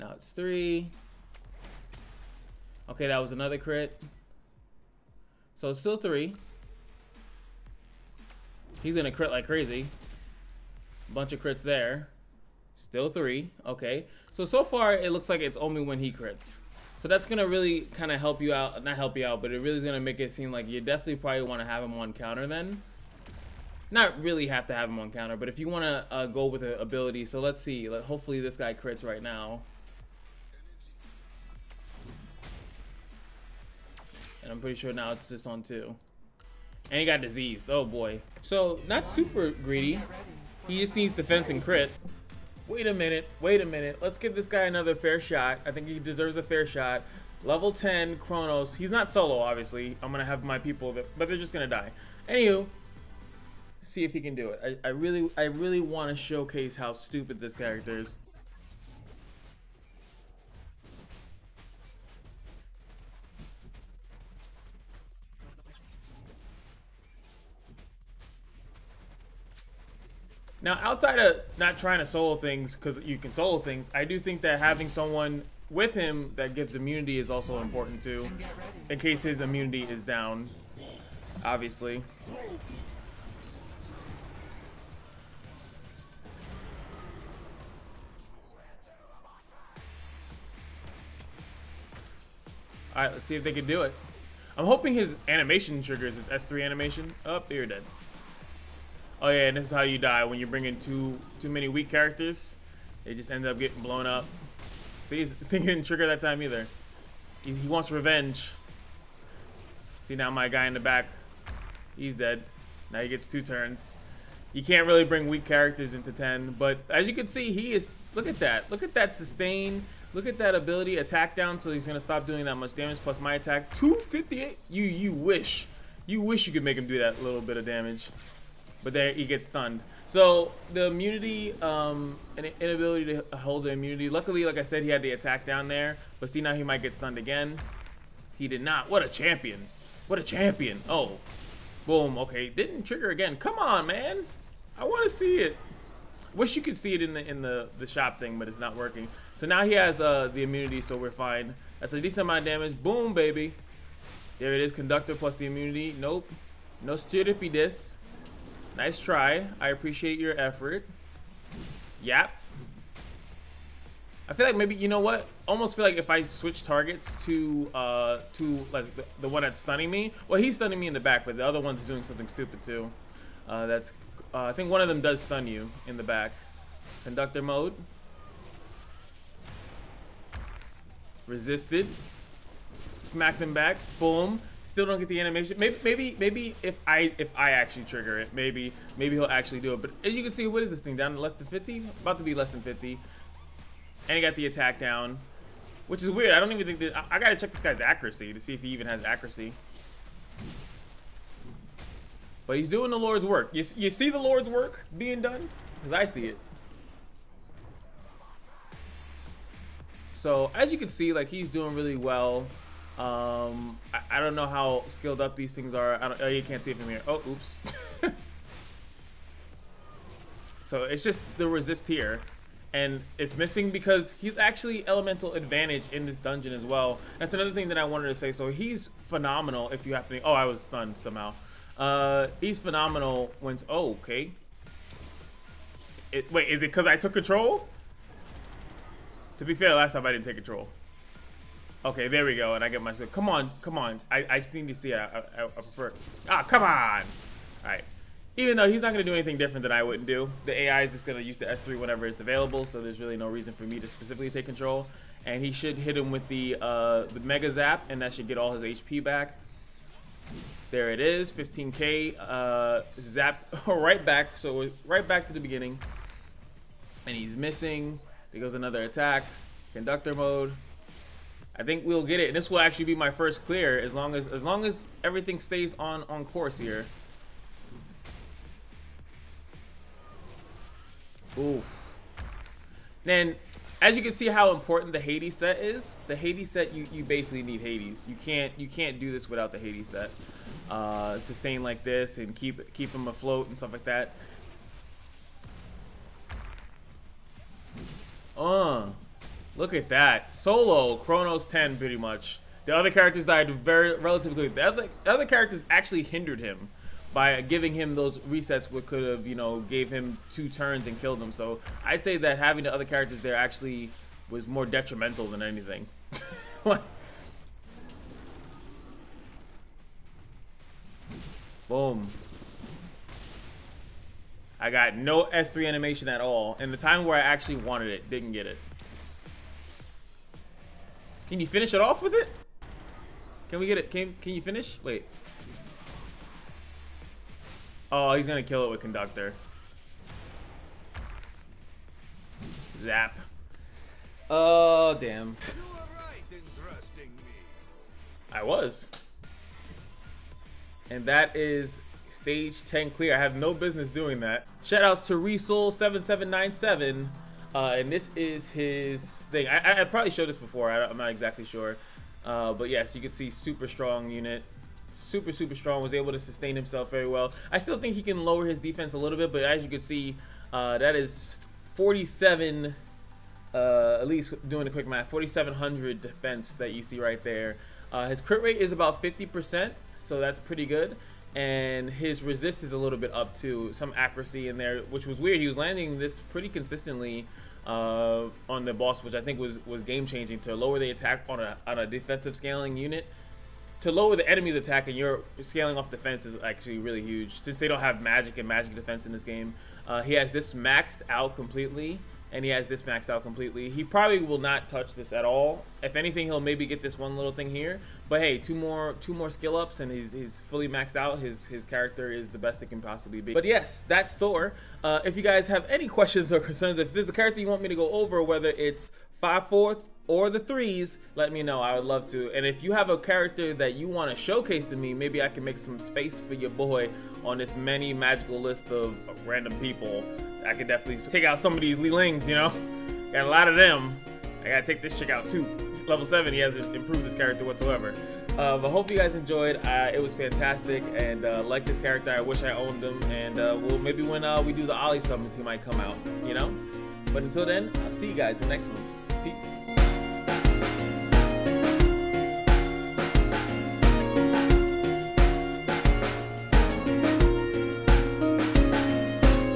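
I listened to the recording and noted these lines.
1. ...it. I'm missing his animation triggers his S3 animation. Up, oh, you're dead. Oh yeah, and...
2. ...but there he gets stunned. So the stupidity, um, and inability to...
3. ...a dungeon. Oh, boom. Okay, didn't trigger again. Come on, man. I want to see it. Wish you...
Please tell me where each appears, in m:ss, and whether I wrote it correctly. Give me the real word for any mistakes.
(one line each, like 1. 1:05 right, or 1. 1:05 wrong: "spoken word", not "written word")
1. 1:33 wrong: "hoping", not "missing"
2. 2:08 wrong: "immunity", not "stupidity"
3. 2:20 wrong: "champion", not "dungeon".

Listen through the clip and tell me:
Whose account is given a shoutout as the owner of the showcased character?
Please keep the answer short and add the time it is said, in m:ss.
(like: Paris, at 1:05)
Resoul7797, at 5:55.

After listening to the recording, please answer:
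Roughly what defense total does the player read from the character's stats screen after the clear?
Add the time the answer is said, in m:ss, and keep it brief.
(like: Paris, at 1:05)
4,700, at 6:15.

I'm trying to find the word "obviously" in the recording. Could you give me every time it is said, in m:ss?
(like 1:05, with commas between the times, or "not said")
0:49, 1:21.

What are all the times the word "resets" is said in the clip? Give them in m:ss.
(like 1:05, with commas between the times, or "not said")
5:08.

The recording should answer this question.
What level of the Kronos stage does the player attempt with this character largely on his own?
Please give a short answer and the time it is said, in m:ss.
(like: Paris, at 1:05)
10, at 0:47.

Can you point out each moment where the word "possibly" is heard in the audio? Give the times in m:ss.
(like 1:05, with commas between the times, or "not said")
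6:52.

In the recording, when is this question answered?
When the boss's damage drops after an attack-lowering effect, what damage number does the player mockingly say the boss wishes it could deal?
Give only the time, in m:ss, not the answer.
2:03.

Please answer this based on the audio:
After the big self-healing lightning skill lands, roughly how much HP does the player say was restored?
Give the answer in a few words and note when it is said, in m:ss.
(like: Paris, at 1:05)
15k, at 4:21.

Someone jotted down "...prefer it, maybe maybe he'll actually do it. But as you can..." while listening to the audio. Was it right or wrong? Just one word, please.
wrong.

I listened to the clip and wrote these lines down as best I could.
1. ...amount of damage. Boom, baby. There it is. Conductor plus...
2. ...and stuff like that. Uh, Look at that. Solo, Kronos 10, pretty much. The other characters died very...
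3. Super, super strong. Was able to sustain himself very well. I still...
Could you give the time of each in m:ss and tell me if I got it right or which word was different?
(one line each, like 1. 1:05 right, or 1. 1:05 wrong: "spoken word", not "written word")
1. 2:32 right
2. 4:53 right
3. 6:04 right.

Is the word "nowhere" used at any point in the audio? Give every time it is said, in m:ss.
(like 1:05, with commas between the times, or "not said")
not said.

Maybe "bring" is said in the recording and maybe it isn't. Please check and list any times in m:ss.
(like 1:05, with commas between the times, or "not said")
1:40, 1:55.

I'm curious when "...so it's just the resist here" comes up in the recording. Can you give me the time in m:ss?
3:40.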